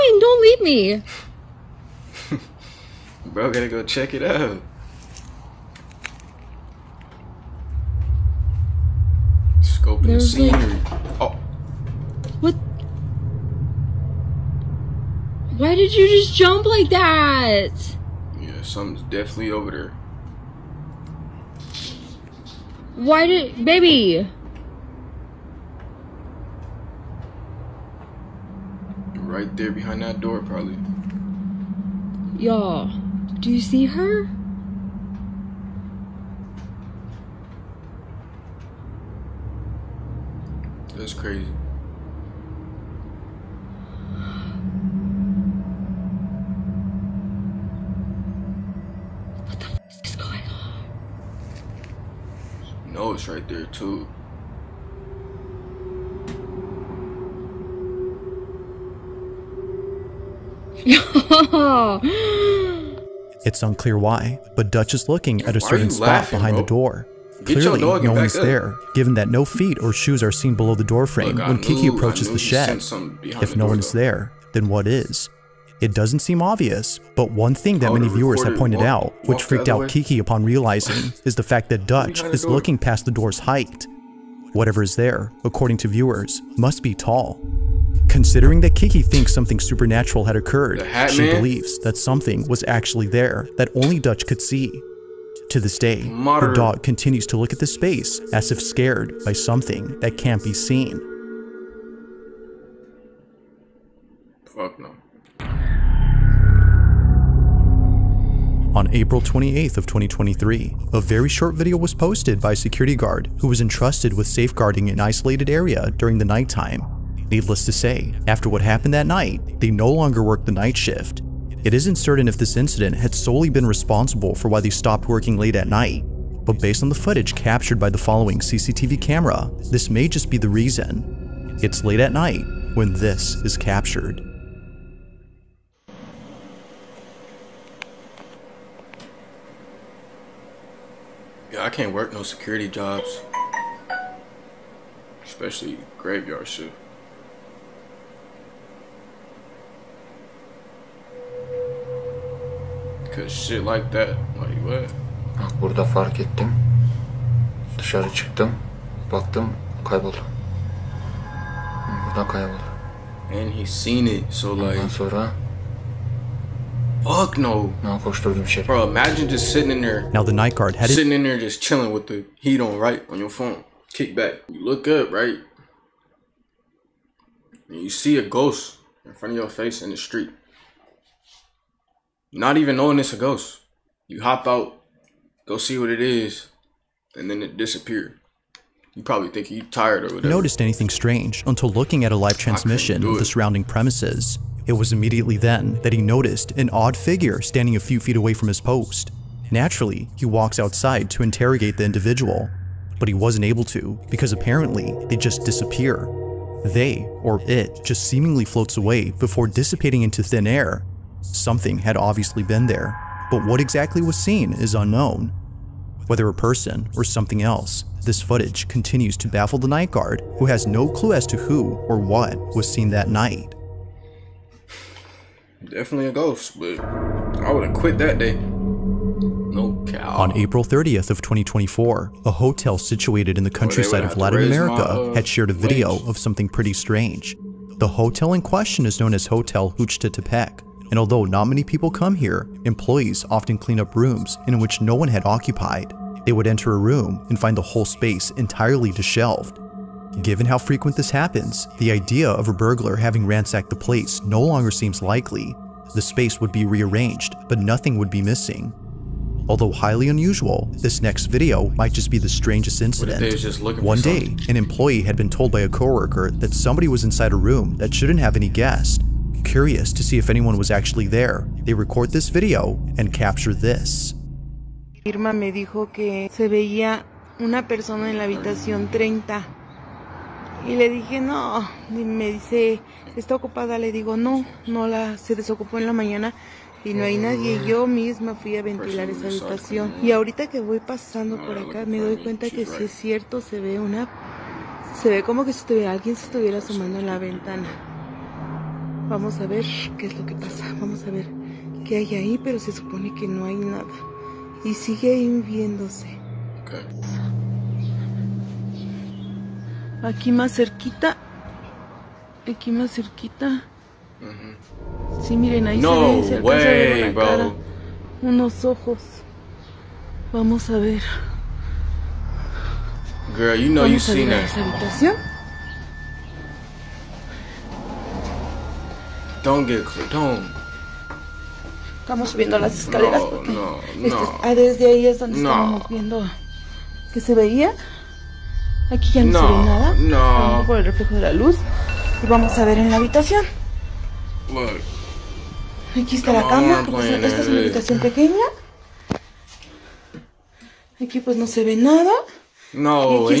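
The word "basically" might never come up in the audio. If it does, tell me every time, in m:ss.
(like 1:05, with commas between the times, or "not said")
not said.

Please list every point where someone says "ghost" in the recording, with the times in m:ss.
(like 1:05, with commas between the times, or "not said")
2:58, 3:03, 3:46.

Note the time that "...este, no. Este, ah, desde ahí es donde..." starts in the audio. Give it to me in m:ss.
5:33.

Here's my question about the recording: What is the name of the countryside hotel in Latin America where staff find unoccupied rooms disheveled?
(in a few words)
Hotel Tepec.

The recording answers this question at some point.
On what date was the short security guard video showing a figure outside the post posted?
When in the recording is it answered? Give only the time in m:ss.
1:48.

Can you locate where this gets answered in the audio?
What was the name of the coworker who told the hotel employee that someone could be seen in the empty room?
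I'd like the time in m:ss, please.
4:35.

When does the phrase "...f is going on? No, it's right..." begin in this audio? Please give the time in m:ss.
0:49.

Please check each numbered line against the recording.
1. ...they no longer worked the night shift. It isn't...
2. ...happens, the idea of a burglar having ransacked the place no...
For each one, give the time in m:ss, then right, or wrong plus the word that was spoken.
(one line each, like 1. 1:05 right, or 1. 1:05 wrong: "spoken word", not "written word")
1. 1:59 right
2. 4:11 right.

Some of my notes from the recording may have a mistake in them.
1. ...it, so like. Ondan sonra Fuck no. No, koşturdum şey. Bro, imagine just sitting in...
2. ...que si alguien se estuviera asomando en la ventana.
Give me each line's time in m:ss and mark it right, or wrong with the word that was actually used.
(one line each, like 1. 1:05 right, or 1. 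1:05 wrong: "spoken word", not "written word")
1. 2:44 right
2. 4:55 right.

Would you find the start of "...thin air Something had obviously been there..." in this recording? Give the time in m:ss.
3:30.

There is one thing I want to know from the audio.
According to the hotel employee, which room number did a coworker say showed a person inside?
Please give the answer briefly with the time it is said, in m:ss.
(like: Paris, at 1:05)
30, at 4:38.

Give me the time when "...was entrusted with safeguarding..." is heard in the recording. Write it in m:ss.
1:53.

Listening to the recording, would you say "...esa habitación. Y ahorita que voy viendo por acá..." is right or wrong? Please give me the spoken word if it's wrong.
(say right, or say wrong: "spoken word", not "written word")
wrong: "pasando", not "viendo".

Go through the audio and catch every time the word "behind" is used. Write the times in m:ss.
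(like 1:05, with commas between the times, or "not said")
0:29, 1:06.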